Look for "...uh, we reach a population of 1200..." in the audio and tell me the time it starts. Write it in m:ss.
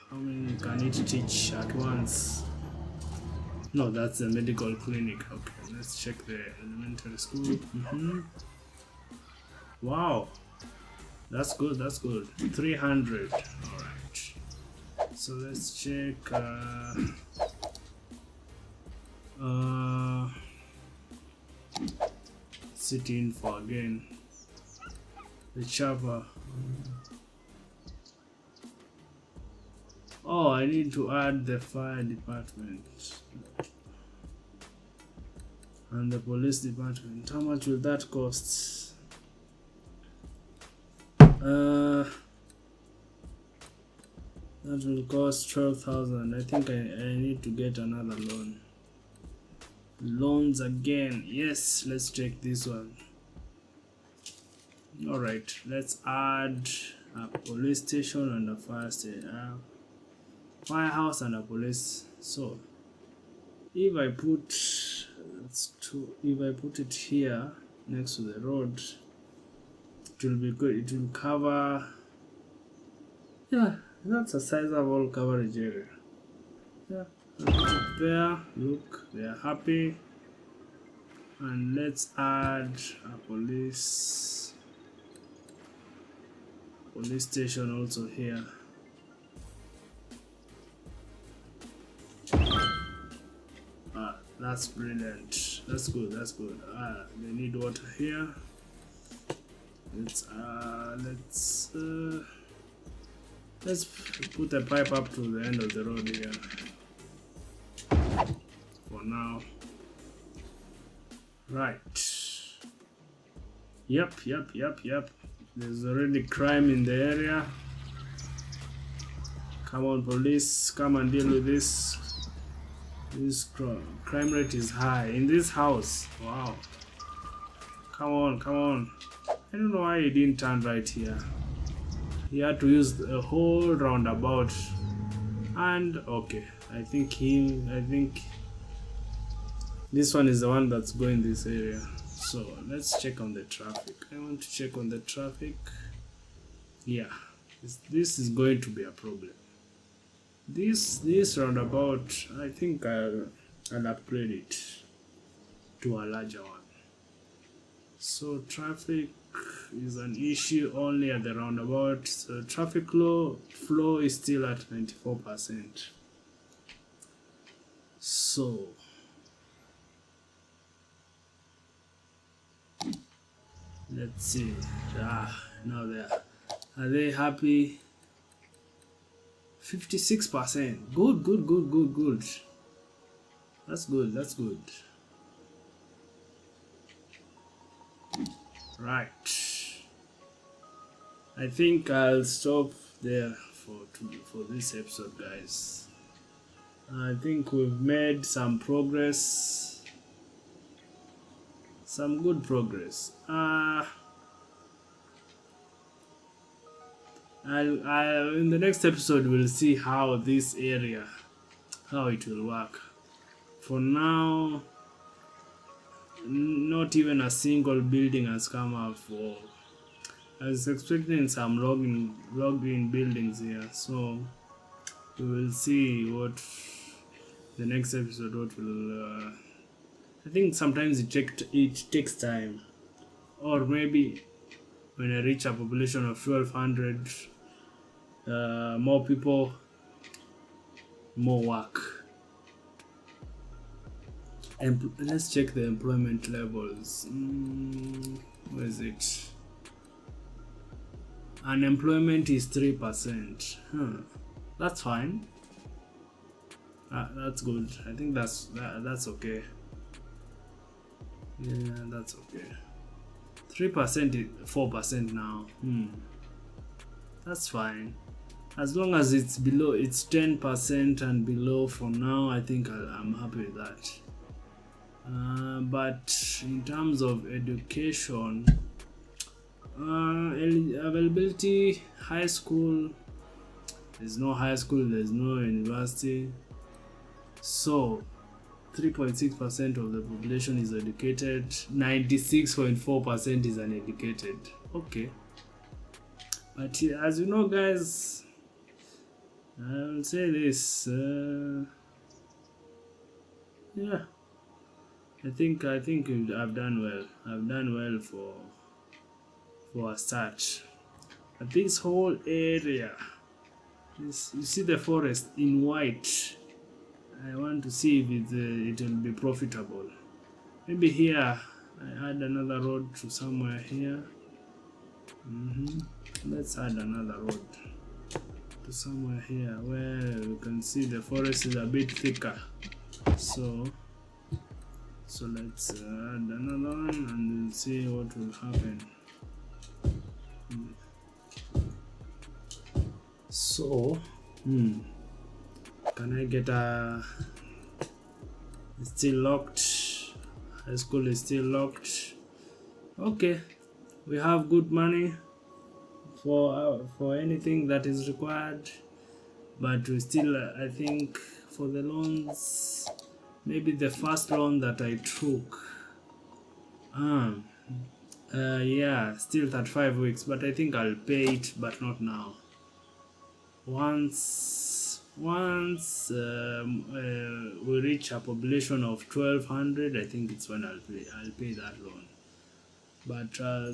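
6:16.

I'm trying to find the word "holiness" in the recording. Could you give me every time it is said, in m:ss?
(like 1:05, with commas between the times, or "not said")
not said.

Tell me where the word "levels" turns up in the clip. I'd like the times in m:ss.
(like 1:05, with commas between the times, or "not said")
4:06.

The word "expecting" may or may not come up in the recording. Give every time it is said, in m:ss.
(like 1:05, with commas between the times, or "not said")
3:40.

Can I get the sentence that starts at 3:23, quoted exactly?
Uh, i i in the next episode we'll see how this area, how it will work.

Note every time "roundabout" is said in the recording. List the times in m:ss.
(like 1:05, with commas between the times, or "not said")
2:13, 2:31, 2:41.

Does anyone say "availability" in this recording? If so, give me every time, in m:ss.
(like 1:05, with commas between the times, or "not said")
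4:40.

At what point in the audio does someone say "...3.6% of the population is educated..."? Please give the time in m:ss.
4:48.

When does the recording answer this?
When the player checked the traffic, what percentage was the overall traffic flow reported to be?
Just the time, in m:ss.
2:44.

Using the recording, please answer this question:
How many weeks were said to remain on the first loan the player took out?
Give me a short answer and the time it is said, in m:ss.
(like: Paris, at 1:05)
35 weeks, at 6:09.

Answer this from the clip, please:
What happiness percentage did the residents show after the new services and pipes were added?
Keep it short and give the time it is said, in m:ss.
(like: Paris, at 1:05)
56 percent, at 2:59.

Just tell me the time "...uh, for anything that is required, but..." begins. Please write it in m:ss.
5:56.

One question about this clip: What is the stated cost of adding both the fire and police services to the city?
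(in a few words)
12,000.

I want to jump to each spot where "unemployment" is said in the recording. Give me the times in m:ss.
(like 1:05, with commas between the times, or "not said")
4:11.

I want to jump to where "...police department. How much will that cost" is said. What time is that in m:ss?
0:36.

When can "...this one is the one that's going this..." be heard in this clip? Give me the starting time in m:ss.
2:19.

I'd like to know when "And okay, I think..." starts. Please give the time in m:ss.
2:15.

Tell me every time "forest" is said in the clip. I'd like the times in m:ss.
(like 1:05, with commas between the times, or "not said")
5:14, 5:31.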